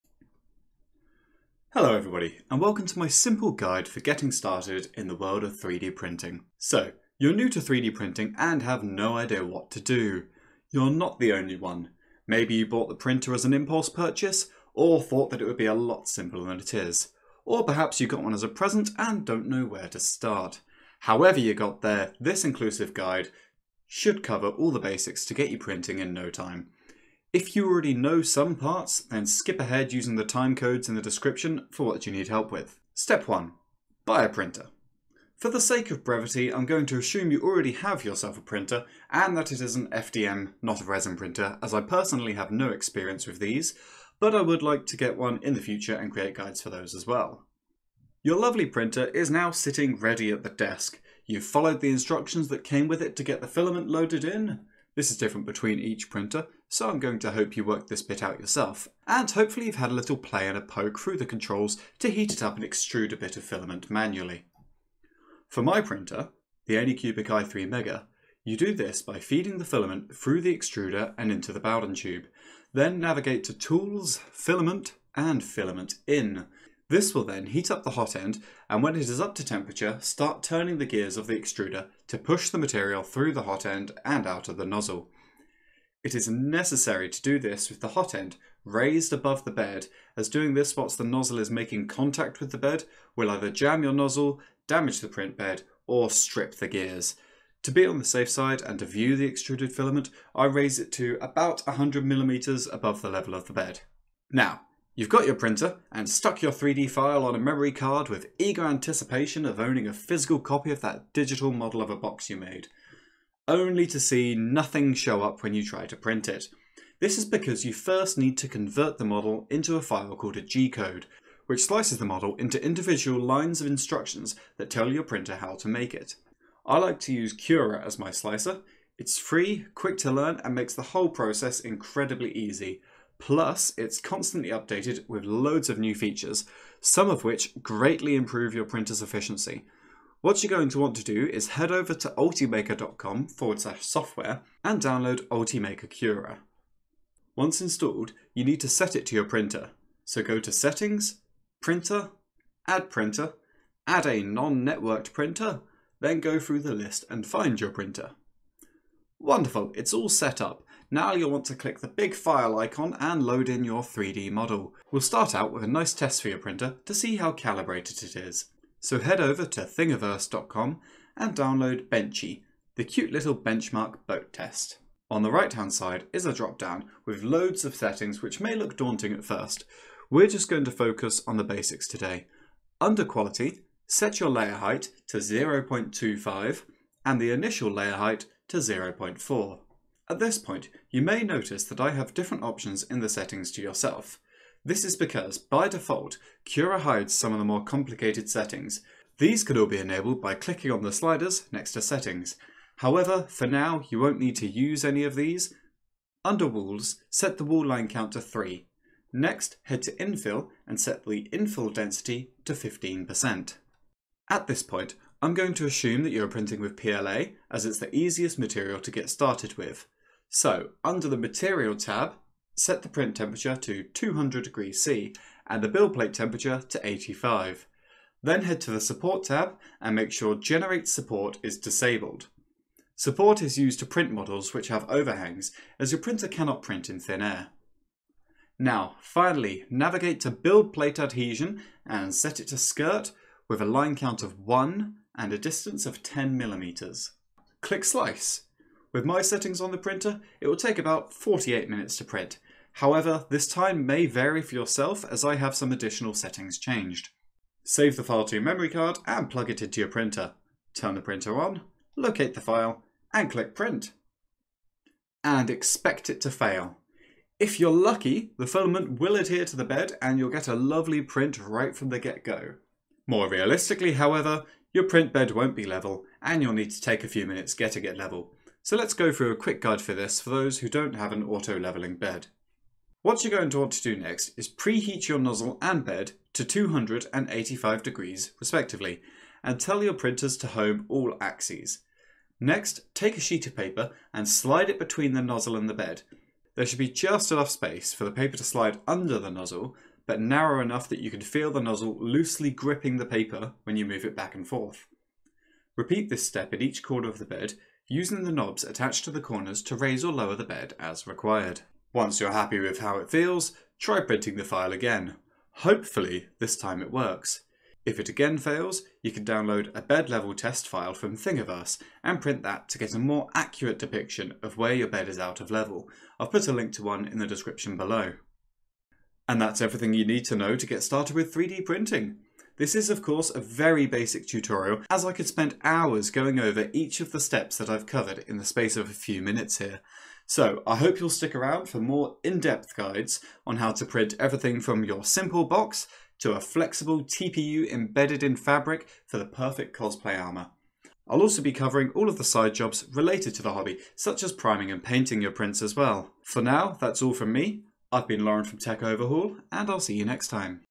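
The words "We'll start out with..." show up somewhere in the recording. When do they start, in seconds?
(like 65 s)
164 s.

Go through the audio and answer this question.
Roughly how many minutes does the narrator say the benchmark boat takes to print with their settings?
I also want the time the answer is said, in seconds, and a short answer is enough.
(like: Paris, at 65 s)
48 minutes, at 251 s.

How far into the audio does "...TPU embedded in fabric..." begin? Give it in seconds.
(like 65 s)
347 s.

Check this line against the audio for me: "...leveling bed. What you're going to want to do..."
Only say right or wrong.
right.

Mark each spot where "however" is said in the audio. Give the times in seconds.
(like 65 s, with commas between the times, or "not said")
20 s, 202 s, 252 s, 273 s.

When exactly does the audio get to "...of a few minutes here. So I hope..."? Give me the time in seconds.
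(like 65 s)
338 s.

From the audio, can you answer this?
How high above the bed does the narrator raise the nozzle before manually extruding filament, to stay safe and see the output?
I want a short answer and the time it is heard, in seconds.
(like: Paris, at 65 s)
100mm, at 101 s.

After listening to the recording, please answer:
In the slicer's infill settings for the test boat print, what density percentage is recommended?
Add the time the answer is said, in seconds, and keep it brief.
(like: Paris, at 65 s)
15%, at 212 s.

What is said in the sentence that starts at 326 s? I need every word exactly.
I've put a link to one in the description below.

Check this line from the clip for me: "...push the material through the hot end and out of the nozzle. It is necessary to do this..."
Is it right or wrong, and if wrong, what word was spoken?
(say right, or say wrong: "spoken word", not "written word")
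right.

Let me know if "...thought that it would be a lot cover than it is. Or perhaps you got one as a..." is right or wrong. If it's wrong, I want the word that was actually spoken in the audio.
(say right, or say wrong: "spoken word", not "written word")
wrong: "simpler", not "cover".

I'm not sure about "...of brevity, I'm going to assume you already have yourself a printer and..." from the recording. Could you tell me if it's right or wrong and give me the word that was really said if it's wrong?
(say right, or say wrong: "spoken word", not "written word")
right.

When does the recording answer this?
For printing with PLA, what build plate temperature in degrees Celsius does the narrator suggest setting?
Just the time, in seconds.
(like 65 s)
226 s.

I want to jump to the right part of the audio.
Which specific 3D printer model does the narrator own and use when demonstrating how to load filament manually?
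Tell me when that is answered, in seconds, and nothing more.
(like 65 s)
66 s.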